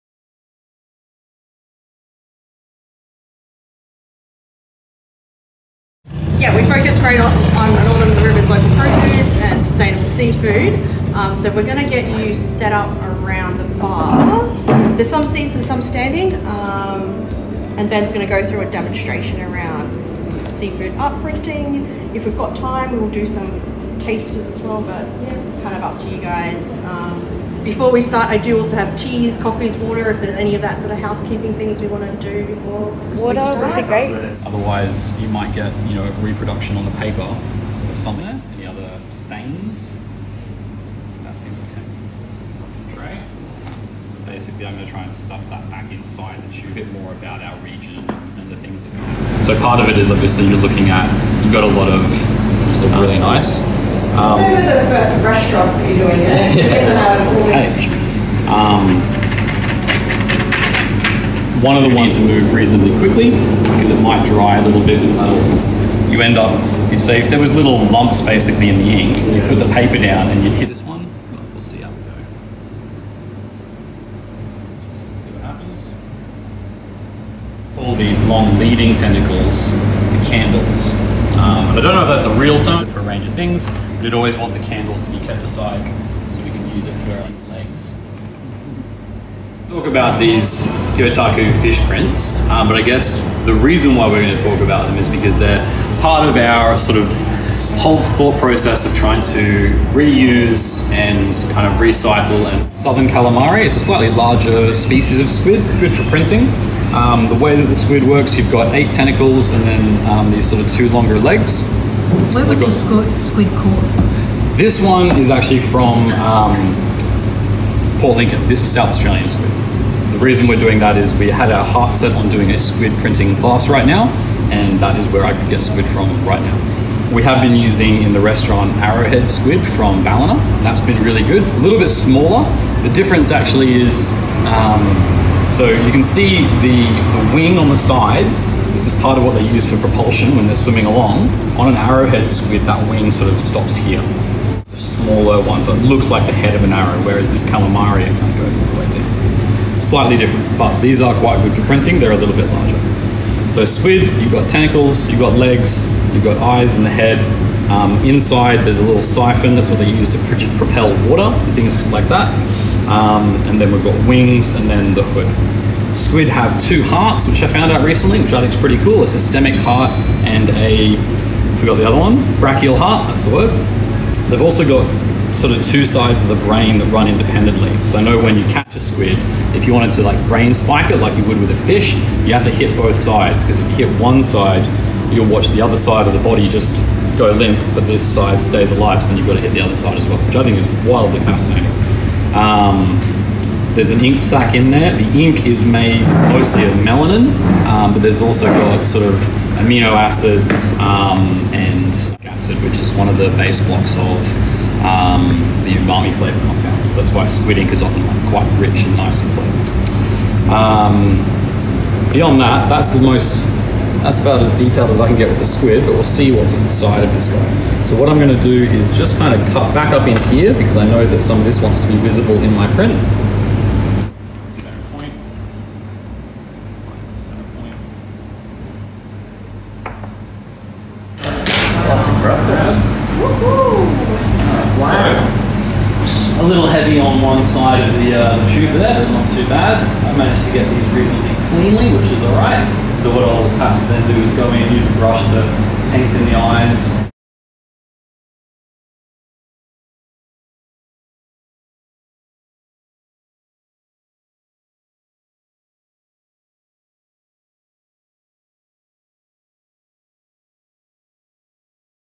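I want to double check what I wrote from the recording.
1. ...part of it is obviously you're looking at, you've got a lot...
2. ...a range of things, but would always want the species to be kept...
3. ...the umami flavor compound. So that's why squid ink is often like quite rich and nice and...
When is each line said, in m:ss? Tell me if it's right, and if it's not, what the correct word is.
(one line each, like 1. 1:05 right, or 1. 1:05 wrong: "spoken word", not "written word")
1. 0:49 right
2. 1:22 wrong: "candles", not "species"
3. 3:25 right.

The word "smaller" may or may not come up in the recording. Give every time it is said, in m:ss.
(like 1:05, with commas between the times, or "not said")
2:11, 2:24.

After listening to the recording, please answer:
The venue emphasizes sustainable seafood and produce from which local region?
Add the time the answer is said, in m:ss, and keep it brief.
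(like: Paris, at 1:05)
Northern Rivers, at 0:07.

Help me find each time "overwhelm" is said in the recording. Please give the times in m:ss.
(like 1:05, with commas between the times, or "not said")
not said.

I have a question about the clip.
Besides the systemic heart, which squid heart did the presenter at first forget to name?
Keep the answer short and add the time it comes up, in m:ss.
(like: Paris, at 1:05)
brachial heart, at 2:52.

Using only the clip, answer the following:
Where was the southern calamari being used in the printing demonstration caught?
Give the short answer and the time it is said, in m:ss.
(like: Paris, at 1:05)
Port Lincoln, at 1:57.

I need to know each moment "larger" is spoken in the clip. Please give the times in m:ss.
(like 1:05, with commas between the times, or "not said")
1:44, 2:32.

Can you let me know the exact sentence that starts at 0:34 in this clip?
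Otherwise, you might get, you know, a reproduction on the paper or something.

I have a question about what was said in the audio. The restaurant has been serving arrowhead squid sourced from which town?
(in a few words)
Ballina.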